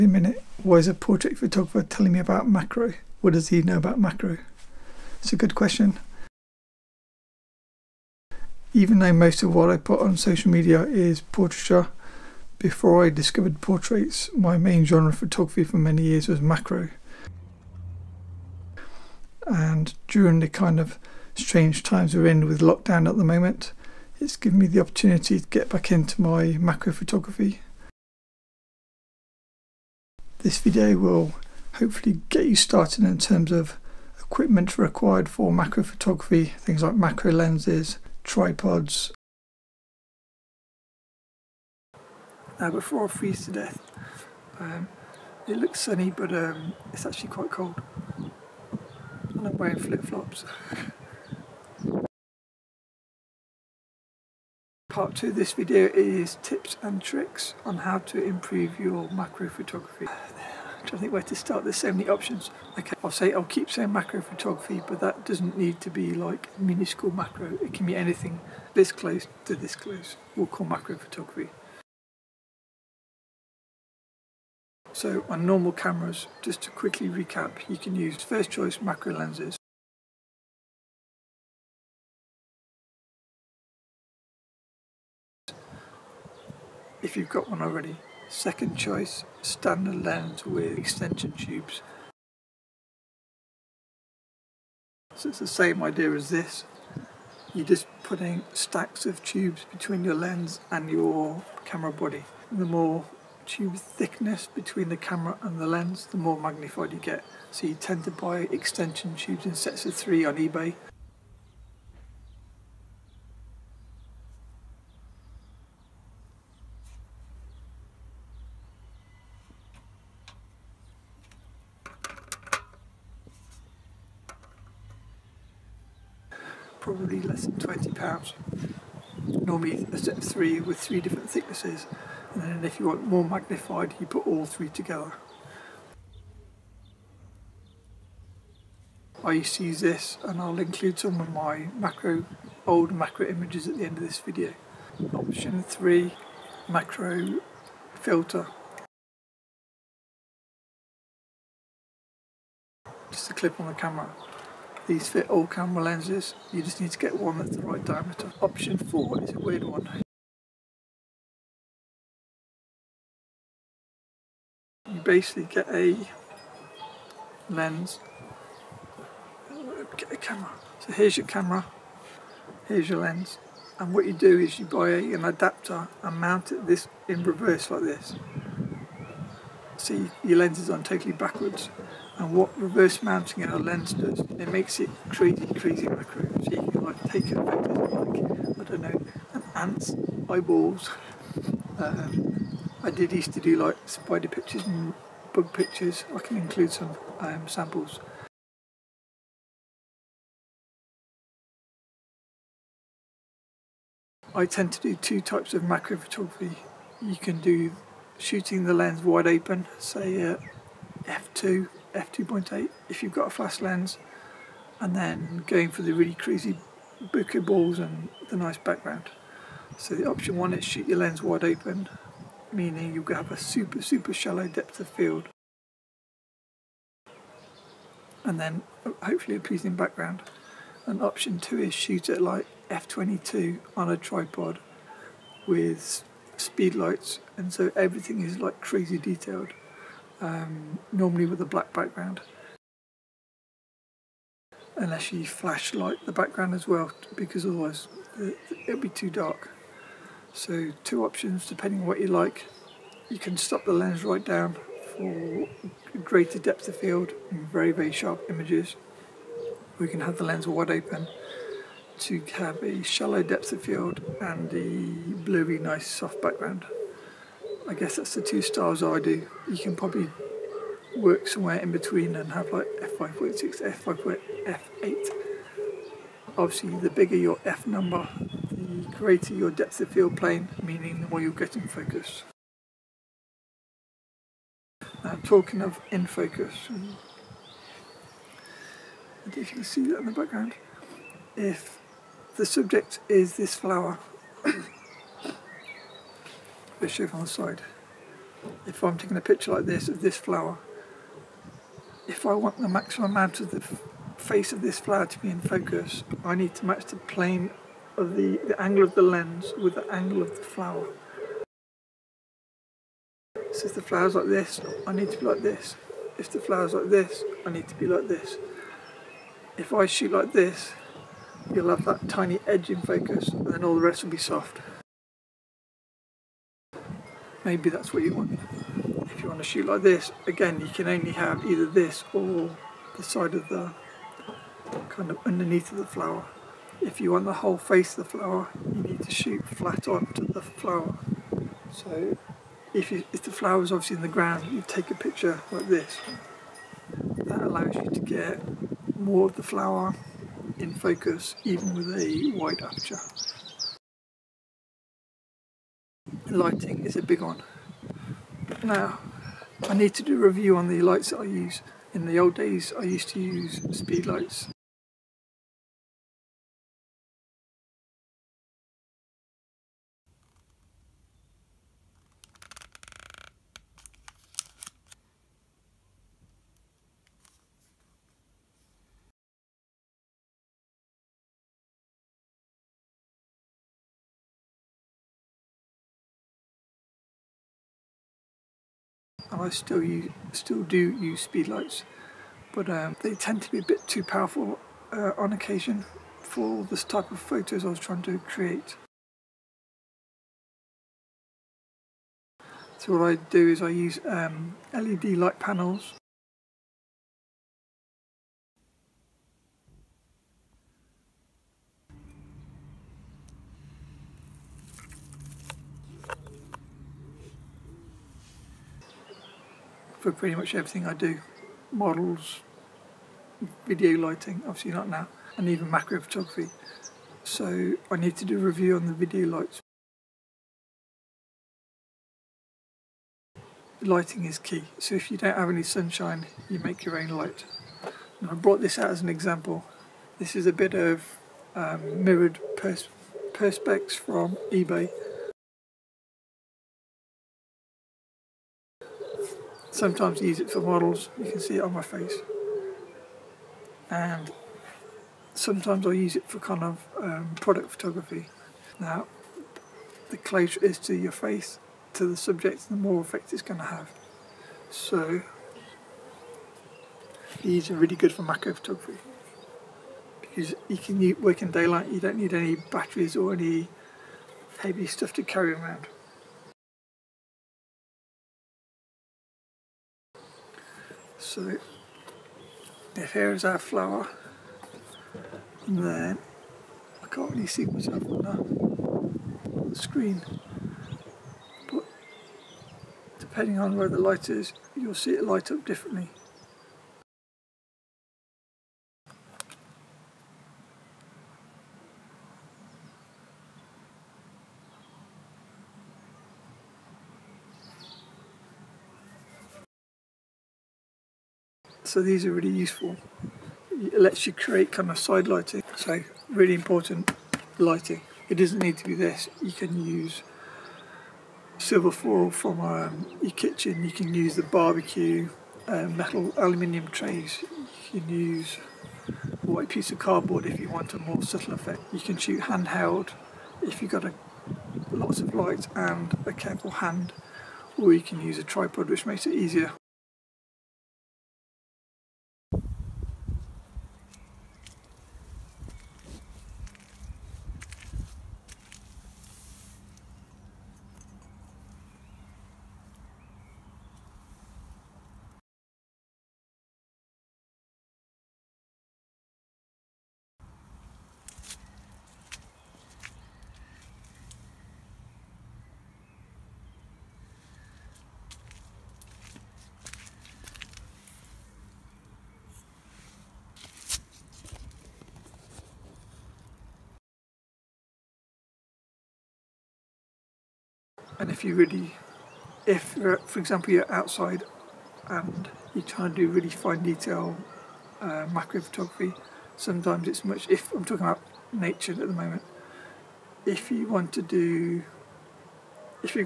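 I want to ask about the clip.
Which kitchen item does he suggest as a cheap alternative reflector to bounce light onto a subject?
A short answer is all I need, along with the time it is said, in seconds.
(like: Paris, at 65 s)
silver foil, at 521 s.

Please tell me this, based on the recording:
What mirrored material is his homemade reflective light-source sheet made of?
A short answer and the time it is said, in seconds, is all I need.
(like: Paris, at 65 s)
perspex, at 443 s.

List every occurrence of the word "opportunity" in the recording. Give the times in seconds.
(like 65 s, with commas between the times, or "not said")
24 s.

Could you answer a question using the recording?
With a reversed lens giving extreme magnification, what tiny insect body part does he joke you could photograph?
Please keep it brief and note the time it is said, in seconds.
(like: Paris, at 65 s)
an ant's eyeballs, at 189 s.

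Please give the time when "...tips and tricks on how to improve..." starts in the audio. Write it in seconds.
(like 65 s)
56 s.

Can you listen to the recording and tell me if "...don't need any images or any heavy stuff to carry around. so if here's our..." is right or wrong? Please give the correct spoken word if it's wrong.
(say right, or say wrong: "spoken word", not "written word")
wrong: "batteries", not "images".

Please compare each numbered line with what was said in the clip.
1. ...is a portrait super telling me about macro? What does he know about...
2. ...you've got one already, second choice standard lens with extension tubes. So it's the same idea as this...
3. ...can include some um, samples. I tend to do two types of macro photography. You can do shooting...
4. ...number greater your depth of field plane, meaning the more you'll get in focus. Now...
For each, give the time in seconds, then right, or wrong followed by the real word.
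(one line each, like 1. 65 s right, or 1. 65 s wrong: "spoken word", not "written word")
1. 0 s wrong: "photographer", not "super"
2. 87 s right
3. 196 s right
4. 277 s right.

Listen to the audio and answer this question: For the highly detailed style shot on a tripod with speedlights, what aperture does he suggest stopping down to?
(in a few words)
f22.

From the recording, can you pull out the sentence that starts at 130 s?
with three different thicknesses and then if you want more magnified you put all three together.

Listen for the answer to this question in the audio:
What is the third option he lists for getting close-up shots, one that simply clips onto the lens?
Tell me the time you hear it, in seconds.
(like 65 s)
146 s.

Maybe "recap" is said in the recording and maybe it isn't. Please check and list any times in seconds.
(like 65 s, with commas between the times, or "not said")
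77 s.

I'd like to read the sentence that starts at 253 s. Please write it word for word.
You can stop the lens right down for greater depth of field and very very sharp images.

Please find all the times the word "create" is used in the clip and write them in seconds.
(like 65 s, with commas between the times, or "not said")
398 s, 514 s.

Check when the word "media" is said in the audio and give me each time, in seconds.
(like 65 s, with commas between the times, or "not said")
10 s.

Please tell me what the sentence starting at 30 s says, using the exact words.
This video will hopefully get you started in terms of equipment required for macro photography, things like macro lenses, tripods.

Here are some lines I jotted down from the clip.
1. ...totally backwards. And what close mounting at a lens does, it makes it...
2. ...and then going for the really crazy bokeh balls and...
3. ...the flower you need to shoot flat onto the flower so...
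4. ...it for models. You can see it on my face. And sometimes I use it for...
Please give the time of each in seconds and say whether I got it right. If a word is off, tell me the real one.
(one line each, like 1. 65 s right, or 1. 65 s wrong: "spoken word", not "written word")
1. 180 s wrong: "reverse", not "close"
2. 214 s right
3. 338 s right
4. 450 s right.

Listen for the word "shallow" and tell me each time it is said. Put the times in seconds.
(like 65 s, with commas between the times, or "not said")
224 s, 262 s.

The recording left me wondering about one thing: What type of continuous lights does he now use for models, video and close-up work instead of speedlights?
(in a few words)
LED light panels.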